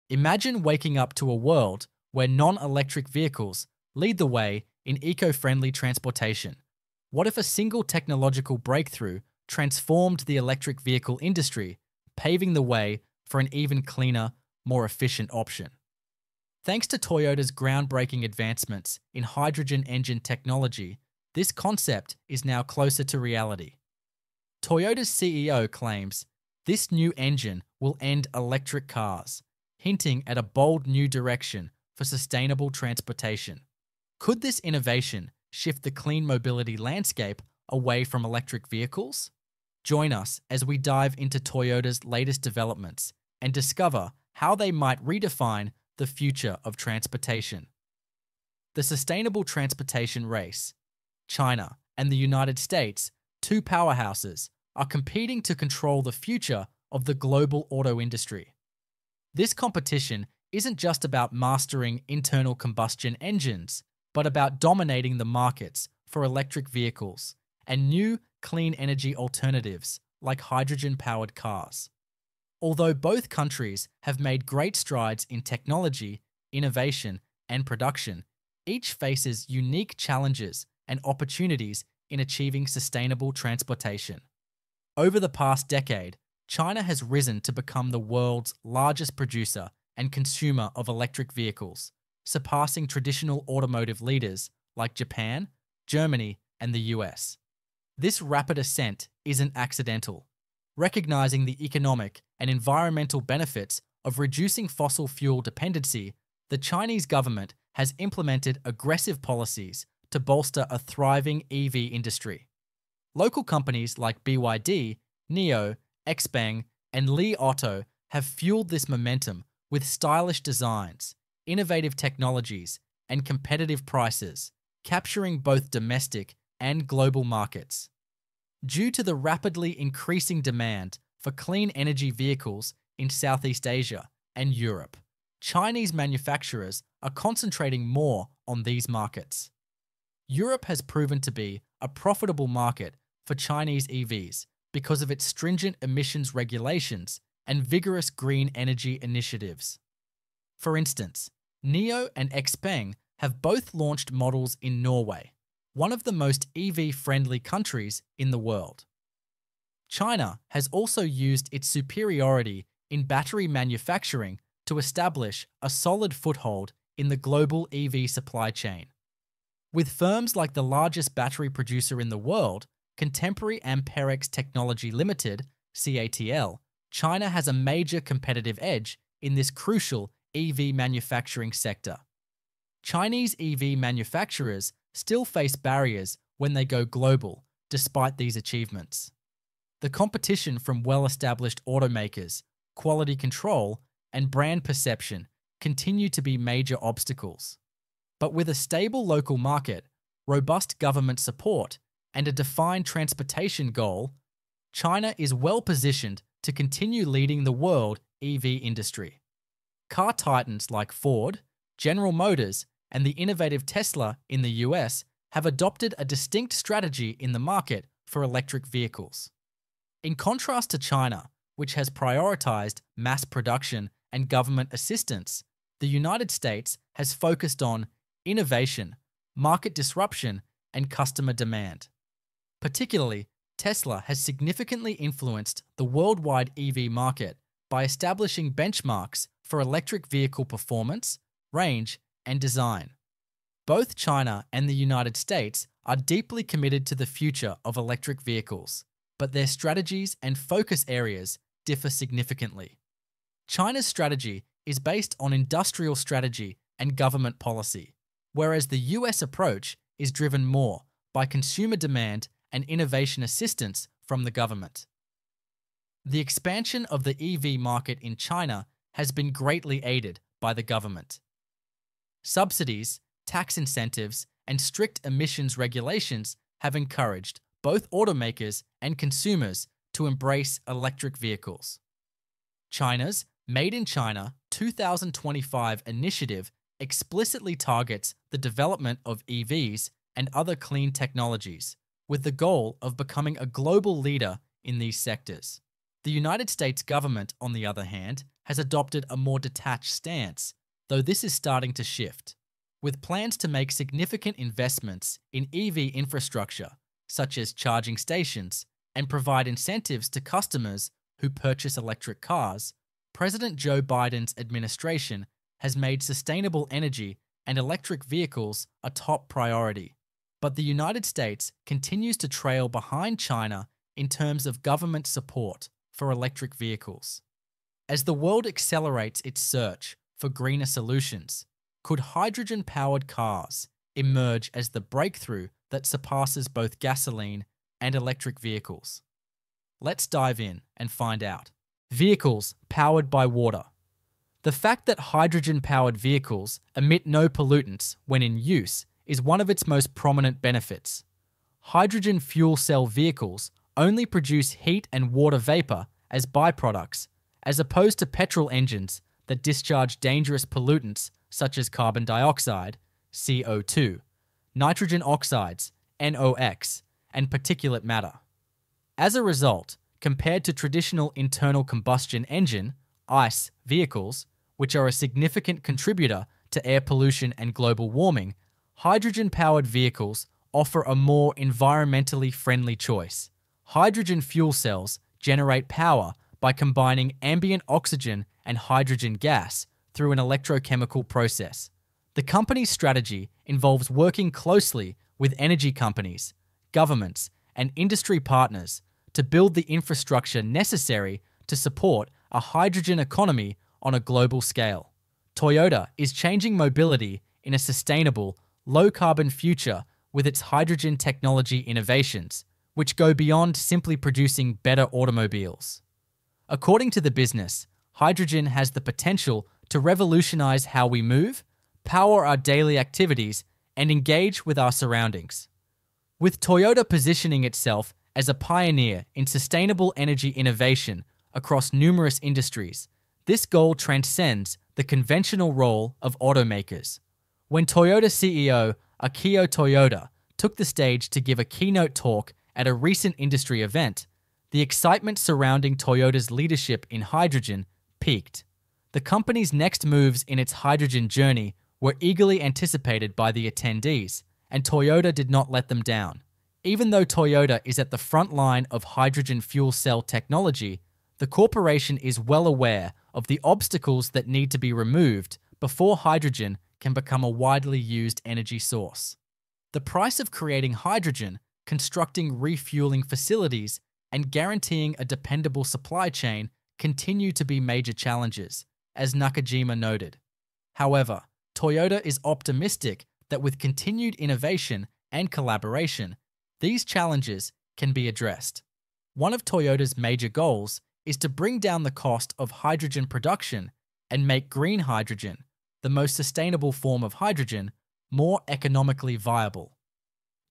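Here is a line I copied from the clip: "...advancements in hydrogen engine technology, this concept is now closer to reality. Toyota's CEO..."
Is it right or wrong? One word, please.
right.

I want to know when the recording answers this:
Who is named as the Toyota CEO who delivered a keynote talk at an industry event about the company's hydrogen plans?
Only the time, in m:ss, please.
7:19.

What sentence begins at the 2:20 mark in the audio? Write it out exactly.
Europe has proven to be a profitable market for Chinese EVs because of its stringent emissions regulations and vigorous green energy initiatives.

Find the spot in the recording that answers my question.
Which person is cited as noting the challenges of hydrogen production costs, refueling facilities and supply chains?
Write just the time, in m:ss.
7:59.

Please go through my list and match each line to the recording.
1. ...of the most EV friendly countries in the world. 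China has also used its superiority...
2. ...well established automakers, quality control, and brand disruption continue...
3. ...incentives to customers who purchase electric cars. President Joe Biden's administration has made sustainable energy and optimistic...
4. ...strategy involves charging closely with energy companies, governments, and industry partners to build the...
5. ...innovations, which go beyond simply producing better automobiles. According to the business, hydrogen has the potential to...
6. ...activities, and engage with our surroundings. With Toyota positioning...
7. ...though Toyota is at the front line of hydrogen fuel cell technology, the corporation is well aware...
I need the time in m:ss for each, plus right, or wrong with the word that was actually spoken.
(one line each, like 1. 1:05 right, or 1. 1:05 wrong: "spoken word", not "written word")
1. 2:35 right
2. 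3:10 wrong: "perception", not "disruption"
3. 5:09 wrong: "electric", not "optimistic"
4. 6:32 wrong: "working", not "charging"
5. 6:51 right
6. 7:02 right
7. 7:36 right.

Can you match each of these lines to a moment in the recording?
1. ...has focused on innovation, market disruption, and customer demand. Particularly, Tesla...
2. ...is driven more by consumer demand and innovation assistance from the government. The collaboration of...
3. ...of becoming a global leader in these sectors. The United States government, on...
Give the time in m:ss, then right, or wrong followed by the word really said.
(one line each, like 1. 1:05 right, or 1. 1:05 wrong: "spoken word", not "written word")
1. 3:46 right
2. 4:19 wrong: "expansion", not "collaboration"
3. 4:52 right.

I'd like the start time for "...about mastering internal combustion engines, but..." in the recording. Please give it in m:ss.
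1:01.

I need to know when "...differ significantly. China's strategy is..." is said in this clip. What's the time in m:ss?
4:11.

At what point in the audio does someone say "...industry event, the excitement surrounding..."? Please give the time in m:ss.
7:23.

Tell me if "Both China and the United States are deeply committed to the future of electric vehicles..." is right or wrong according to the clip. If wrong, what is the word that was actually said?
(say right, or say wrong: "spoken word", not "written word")
right.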